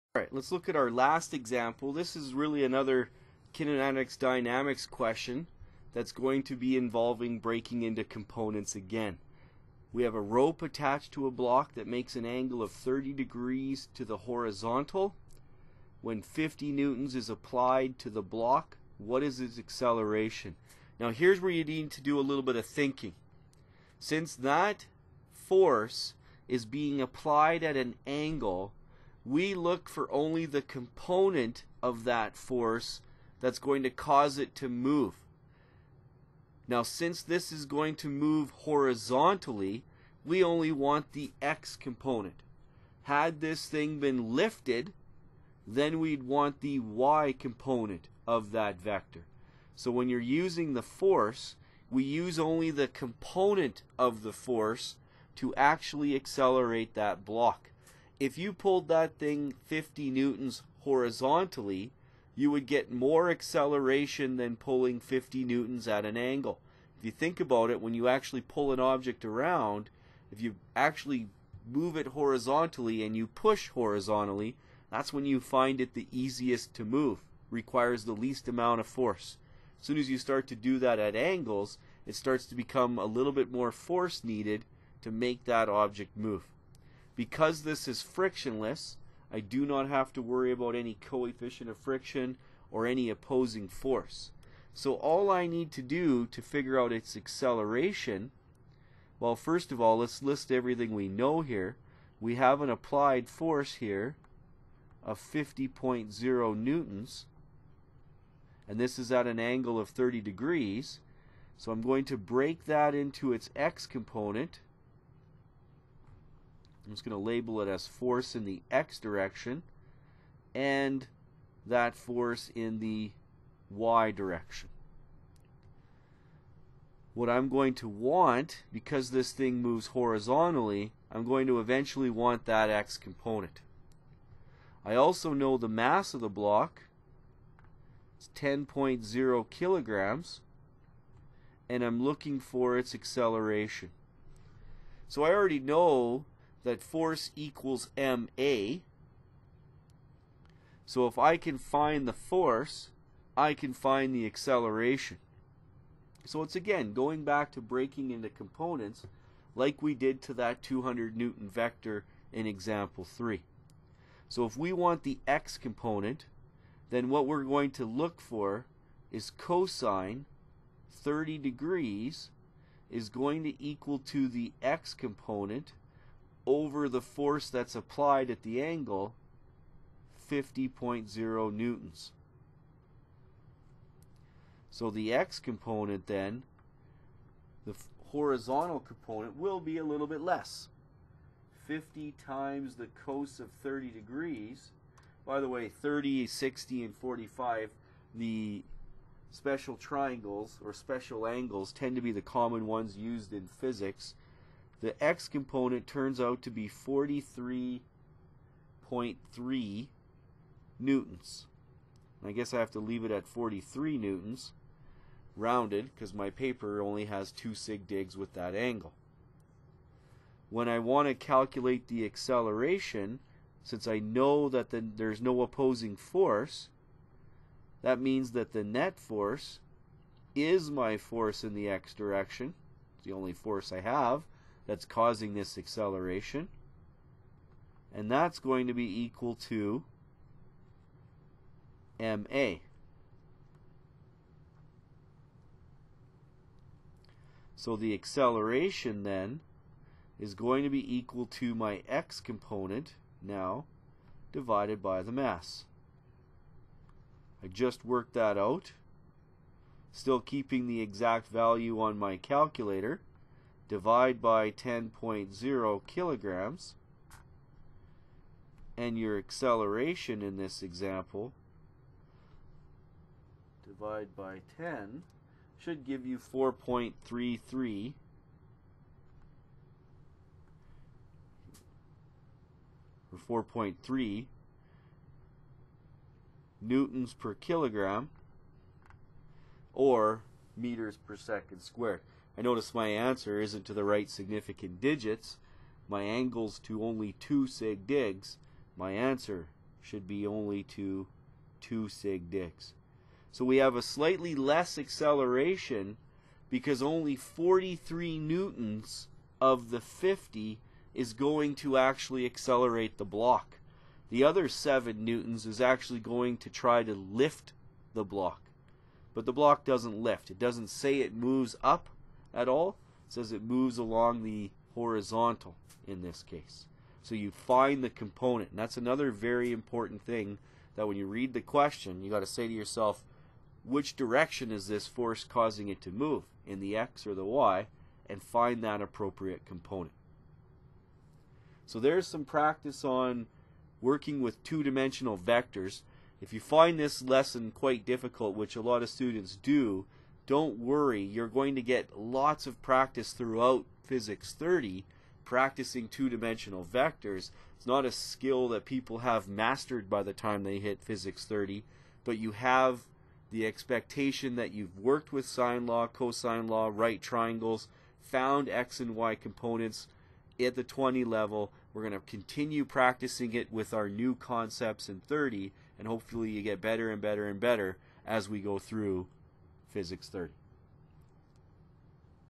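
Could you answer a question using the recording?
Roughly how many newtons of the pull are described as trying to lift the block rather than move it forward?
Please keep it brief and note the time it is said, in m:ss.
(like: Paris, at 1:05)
7 newtons, at 5:14.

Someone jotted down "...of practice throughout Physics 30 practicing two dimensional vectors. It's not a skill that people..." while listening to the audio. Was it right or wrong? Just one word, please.
right.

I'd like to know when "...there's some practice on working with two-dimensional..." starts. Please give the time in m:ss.
5:41.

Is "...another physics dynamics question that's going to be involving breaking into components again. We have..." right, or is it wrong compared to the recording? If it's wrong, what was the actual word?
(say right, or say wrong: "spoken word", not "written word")
wrong: "kinematics", not "physics".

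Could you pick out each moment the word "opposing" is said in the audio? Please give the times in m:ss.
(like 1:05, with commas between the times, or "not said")
1:33, 3:45.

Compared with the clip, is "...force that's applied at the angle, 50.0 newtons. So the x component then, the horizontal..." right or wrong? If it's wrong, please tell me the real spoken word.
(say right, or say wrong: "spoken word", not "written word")
right.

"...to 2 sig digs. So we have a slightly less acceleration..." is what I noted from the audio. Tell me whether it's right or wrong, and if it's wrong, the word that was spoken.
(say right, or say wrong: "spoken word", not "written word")
right.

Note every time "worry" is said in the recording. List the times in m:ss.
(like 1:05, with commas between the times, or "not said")
1:30, 5:50.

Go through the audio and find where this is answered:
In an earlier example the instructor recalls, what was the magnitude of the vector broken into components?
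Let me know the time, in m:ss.
2:40.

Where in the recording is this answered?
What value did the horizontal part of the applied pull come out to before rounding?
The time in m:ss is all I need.
3:26.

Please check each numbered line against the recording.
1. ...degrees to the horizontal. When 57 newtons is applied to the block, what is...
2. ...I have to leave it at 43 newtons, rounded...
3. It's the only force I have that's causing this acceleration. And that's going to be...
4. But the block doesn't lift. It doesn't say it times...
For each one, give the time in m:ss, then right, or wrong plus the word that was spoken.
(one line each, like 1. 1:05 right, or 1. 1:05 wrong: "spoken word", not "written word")
1. 0:13 wrong: "50", not "57"
2. 3:32 right
3. 3:52 right
4. 5:19 wrong: "moves", not "times".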